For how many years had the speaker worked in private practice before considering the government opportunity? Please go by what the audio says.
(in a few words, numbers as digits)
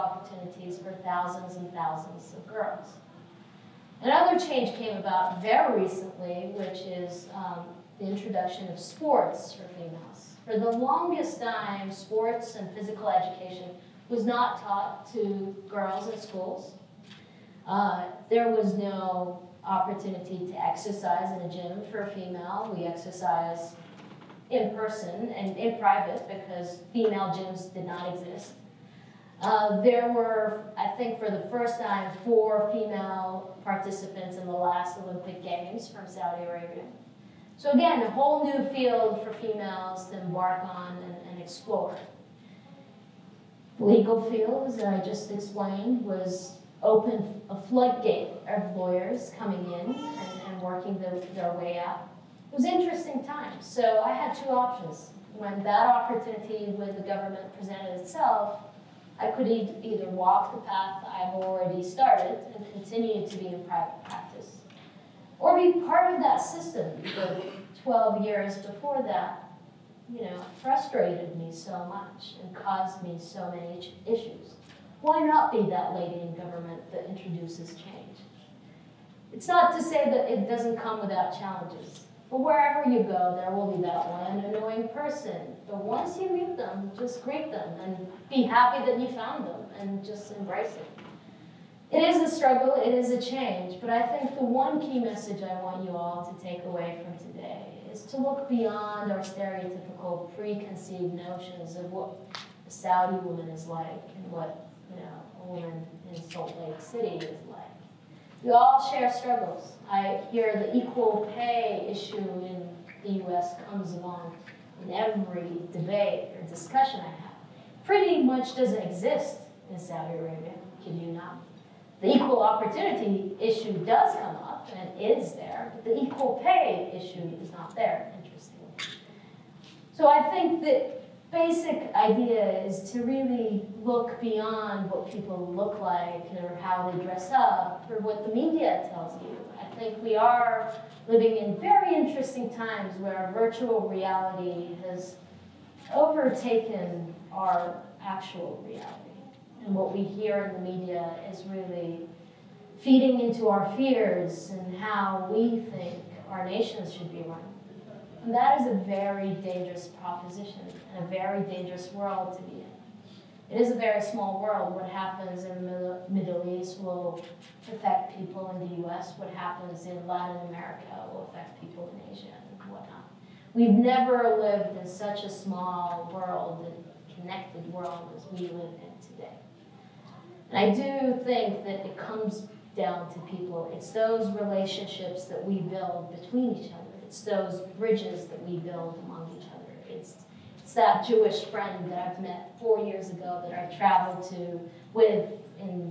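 12.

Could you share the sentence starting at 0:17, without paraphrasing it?
Uh, there was no opportunity to exercise in a gym for a female.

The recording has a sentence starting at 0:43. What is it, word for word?
legal fields, as I just explained, was open a floodgate of lawyers coming in and, and working the, their way up.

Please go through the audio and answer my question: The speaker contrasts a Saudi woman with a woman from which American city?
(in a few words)
Salt Lake City.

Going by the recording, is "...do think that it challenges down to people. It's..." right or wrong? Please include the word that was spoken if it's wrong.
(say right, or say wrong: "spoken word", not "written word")
wrong: "comes", not "challenges".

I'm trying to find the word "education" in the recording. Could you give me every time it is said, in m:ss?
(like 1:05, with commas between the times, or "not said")
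0:13.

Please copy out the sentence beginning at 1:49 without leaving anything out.
I hear the equal pay issue in the US comes along in every debate or discussion I have.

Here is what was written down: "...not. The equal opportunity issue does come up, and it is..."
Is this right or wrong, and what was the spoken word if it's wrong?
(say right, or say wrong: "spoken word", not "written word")
right.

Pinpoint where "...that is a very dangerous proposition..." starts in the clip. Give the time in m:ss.
2:38.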